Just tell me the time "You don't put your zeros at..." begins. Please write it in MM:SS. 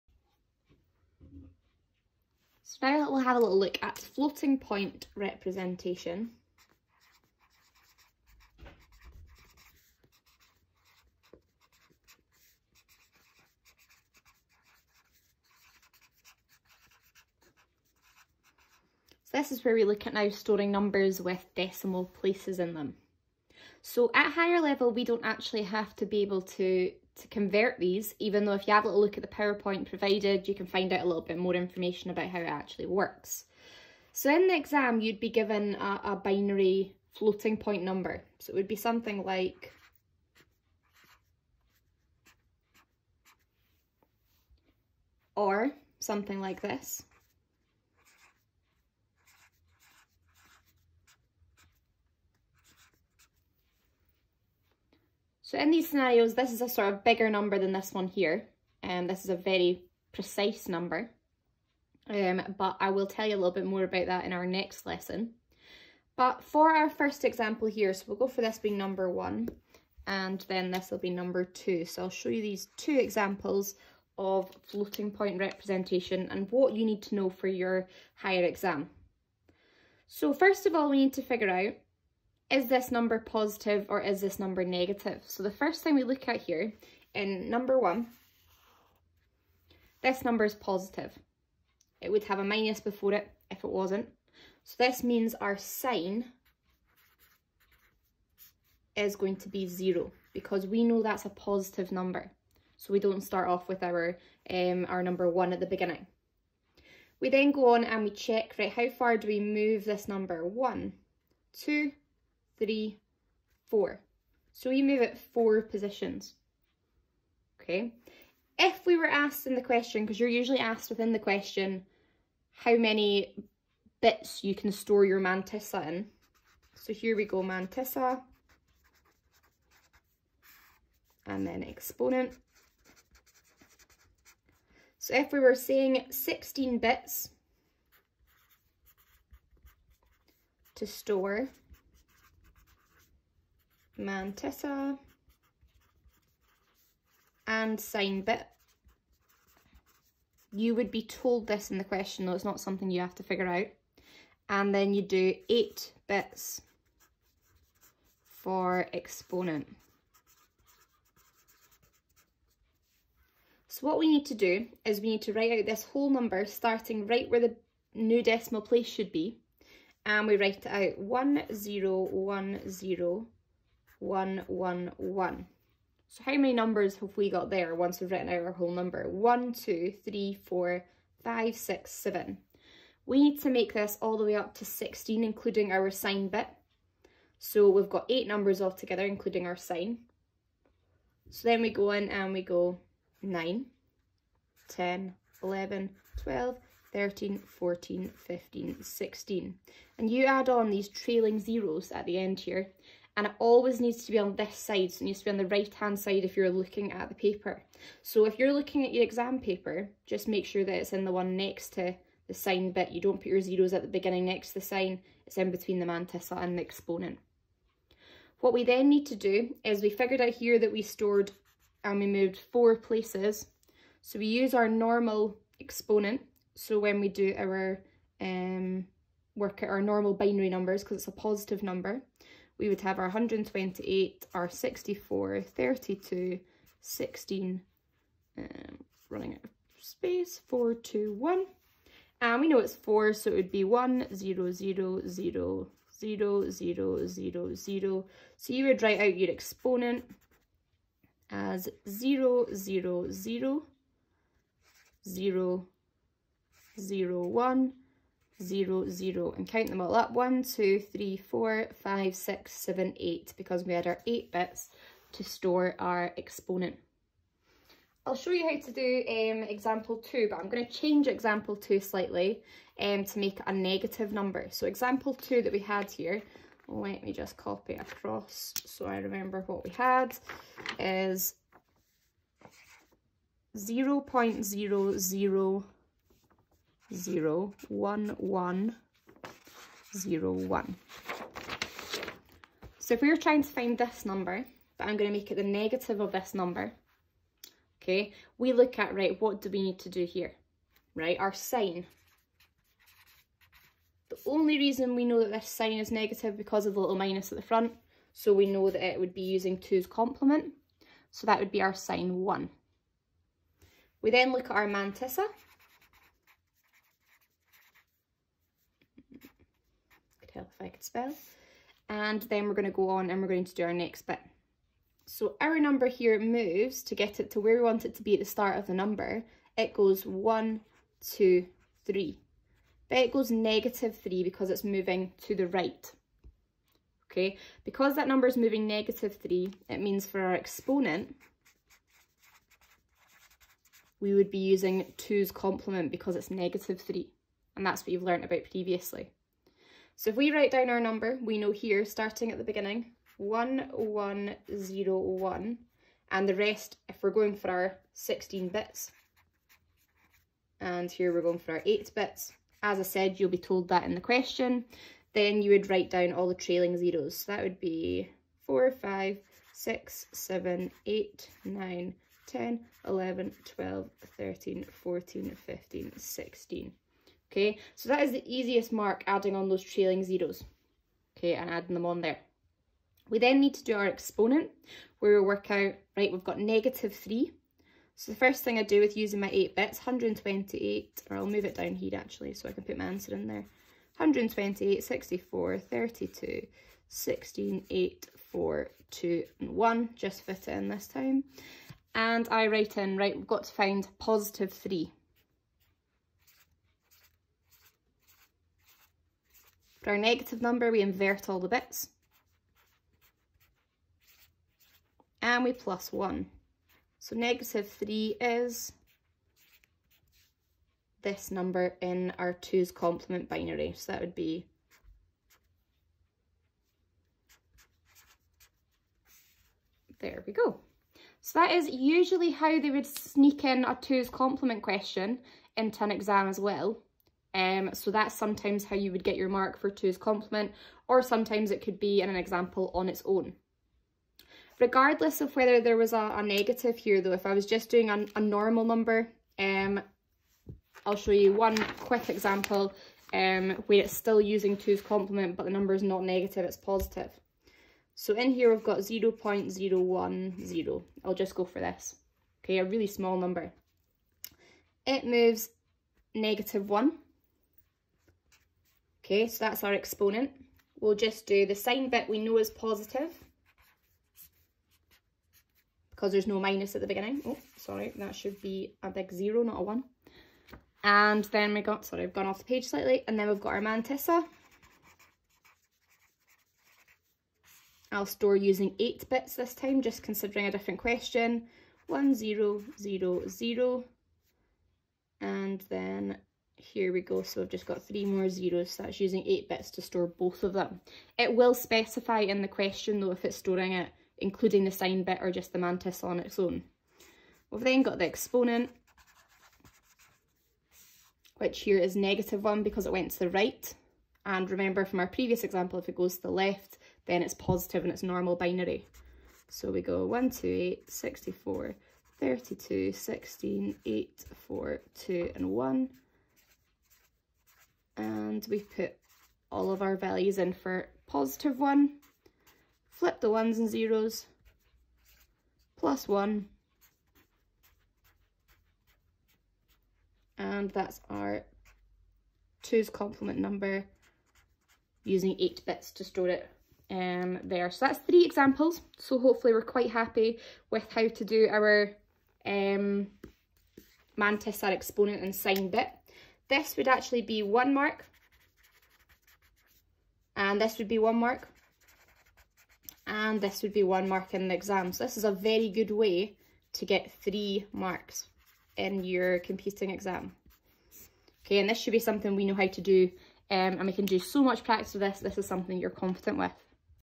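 03:32.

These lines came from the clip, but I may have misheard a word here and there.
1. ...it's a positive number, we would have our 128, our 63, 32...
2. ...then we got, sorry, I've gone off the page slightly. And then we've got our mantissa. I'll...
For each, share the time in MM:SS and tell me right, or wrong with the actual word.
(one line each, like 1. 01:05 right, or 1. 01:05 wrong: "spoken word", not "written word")
1. 03:50 wrong: "64", not "63"
2. 08:01 right.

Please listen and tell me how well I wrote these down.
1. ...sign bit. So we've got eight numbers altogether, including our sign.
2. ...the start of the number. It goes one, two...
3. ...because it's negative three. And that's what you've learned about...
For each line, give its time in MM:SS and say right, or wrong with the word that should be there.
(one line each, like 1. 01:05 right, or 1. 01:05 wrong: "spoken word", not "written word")
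1. 03:05 right
2. 05:28 right
3. 05:45 right.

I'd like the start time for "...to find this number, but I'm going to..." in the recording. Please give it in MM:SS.
04:53.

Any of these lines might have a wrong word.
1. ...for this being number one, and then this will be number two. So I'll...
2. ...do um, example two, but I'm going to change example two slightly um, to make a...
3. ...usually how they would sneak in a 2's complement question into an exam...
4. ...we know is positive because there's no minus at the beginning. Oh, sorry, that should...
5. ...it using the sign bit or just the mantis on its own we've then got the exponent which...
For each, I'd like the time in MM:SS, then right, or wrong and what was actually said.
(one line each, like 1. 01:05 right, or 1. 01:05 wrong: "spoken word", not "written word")
1. 01:08 right
2. 04:28 right
3. 07:11 right
4. 07:52 right
5. 08:23 wrong: "including", not "using".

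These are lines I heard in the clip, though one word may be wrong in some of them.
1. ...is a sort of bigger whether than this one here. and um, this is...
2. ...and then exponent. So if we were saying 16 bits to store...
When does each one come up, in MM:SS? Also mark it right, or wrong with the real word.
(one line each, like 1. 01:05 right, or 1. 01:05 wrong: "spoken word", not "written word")
1. 00:56 wrong: "number", not "whether"
2. 02:11 right.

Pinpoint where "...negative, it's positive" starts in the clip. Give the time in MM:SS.
07:36.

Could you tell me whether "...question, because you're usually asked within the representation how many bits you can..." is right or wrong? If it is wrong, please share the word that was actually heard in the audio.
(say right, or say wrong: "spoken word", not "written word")
wrong: "question", not "representation".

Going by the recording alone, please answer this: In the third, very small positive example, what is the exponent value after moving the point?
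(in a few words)
-1.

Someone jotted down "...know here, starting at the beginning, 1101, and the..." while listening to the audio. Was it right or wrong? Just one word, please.
right.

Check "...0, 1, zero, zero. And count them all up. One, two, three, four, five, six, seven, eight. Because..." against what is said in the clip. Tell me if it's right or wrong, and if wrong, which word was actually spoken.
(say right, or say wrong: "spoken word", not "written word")
right.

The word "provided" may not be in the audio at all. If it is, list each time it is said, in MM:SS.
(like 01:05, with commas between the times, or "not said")
00:29.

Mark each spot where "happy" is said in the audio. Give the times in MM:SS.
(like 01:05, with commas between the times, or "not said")
09:09.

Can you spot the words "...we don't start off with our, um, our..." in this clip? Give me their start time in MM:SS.
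01:42.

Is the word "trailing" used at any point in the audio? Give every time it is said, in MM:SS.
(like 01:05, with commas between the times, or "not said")
03:20, 06:06, 06:19.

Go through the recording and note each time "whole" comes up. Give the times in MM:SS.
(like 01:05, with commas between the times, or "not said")
02:45, 02:58.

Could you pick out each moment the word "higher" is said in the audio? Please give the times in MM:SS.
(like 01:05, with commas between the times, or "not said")
00:24, 01:18.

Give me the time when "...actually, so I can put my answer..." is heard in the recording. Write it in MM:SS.
06:31.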